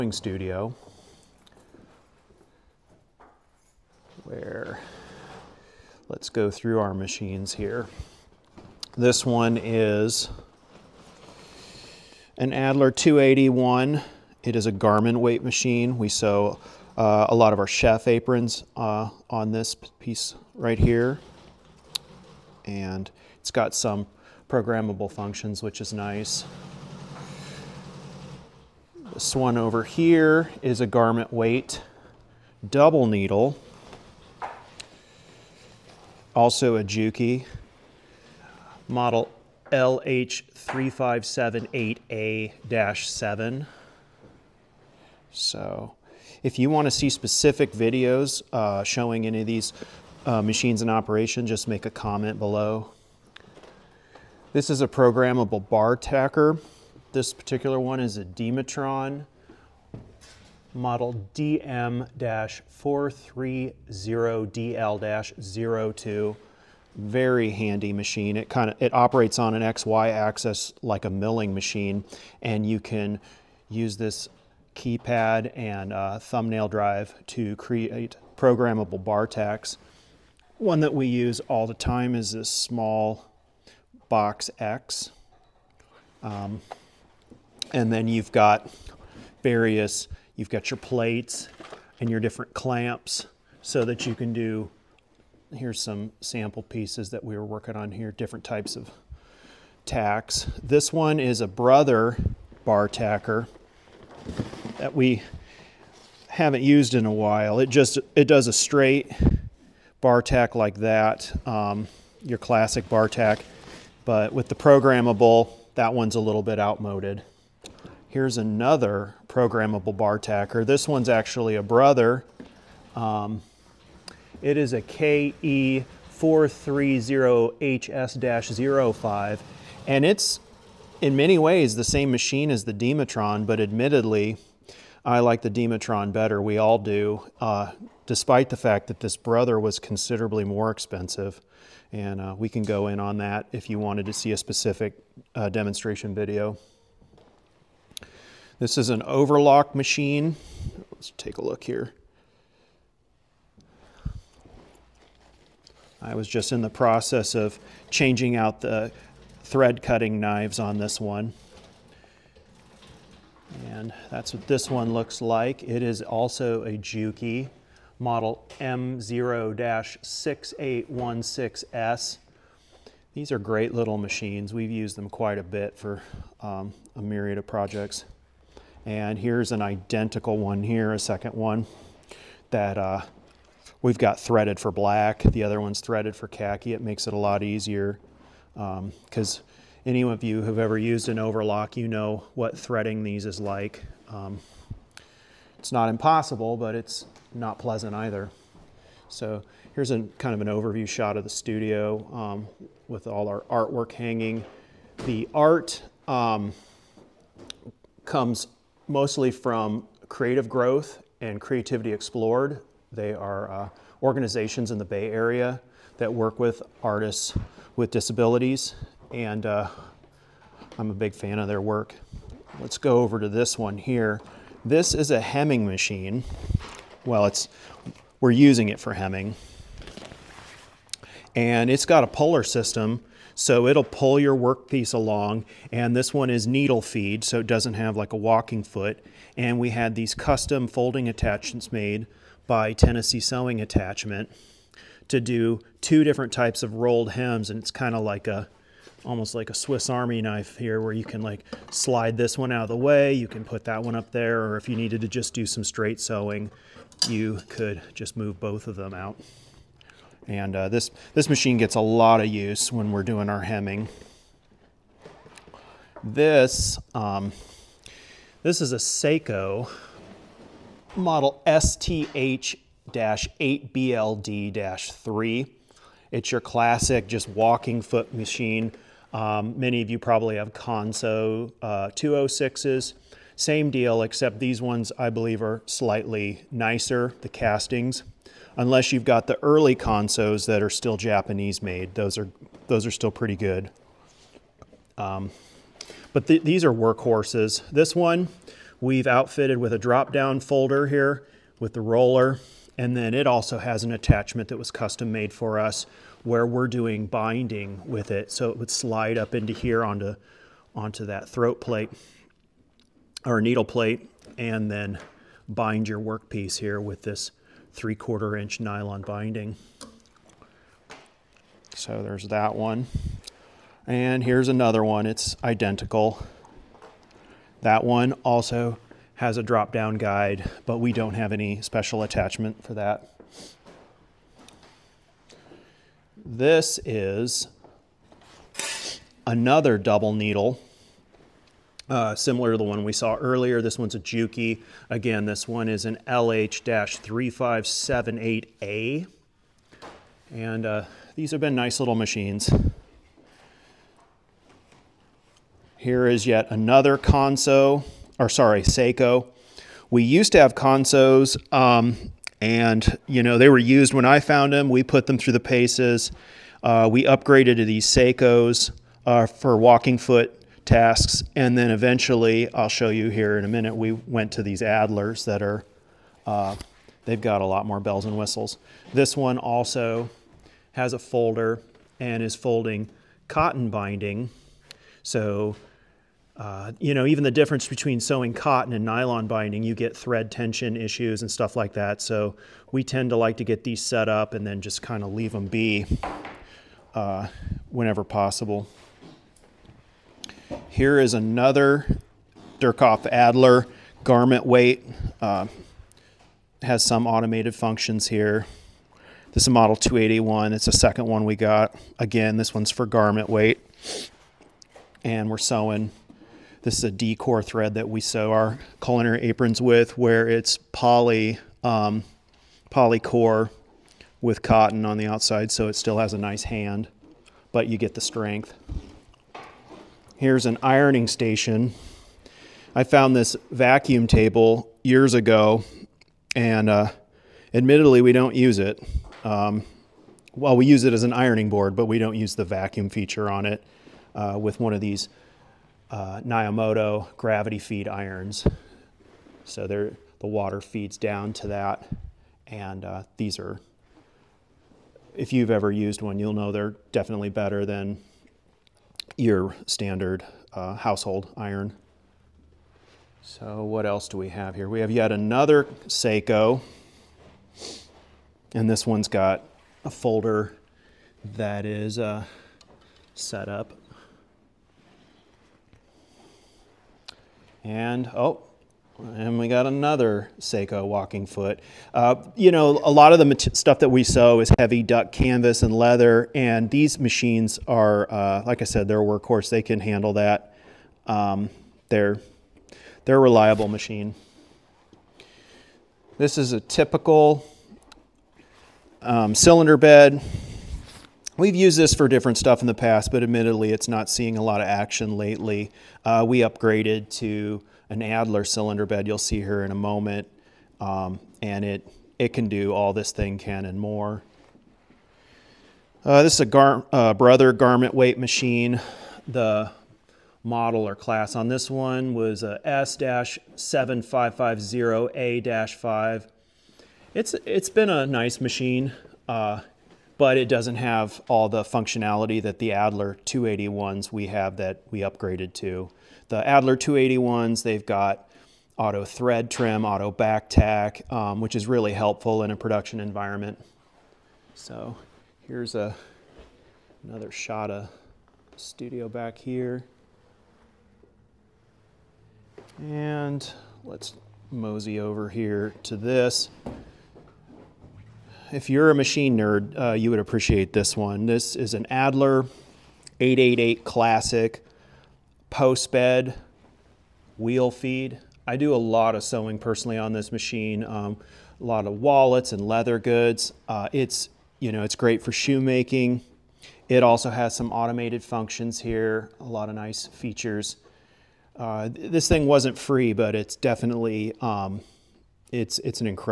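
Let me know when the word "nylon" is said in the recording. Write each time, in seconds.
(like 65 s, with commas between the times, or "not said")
318 s, 388 s.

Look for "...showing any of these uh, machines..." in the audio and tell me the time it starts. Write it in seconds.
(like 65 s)
48 s.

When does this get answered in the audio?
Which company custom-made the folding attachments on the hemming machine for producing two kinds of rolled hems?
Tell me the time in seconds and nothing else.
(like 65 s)
242 s.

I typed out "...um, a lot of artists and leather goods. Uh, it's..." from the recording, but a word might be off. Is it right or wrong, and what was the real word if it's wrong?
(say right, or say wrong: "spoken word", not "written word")
wrong: "wallets", not "artists".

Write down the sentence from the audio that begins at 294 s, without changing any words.
Um, but th these are workhorses.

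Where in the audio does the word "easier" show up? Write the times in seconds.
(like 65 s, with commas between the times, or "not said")
187 s.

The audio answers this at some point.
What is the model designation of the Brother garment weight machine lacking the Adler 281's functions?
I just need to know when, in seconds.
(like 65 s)
522 s.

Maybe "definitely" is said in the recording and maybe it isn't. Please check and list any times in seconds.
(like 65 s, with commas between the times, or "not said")
456 s, 583 s.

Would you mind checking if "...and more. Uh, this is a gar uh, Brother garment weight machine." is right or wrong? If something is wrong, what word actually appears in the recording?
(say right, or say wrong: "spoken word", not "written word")
right.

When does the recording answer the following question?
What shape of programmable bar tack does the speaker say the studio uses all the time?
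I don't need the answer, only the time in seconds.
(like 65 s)
82 s.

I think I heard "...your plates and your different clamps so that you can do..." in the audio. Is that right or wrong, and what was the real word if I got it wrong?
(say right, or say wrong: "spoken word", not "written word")
right.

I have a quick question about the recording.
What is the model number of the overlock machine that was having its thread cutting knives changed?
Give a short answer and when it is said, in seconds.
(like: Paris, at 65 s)
MO-6816S, at 168 s.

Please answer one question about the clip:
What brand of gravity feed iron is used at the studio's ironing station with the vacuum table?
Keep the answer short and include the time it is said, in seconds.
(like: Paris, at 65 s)
Naomoto, at 446 s.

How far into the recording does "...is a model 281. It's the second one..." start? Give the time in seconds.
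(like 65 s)
409 s.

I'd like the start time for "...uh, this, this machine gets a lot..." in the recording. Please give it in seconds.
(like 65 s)
260 s.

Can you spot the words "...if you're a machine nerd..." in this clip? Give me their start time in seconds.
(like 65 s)
558 s.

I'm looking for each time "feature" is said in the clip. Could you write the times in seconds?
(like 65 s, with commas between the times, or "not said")
442 s, 580 s.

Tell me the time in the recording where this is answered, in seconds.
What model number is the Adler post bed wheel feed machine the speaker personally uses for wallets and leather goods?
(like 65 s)
563 s.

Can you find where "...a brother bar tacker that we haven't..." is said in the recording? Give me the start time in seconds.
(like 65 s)
101 s.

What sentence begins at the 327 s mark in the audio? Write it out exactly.
That one also has a drop down guide, but we don't have any special attachment for that.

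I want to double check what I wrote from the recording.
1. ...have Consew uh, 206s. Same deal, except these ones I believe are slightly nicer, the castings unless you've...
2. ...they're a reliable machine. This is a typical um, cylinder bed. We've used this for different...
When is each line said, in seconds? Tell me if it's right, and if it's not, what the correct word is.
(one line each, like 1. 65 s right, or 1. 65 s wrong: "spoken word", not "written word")
1. 280 s right
2. 493 s right.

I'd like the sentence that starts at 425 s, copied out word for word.
So it still has a nice hand, but you get the strength.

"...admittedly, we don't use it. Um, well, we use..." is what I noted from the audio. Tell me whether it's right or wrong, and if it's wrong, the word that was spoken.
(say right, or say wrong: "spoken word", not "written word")
right.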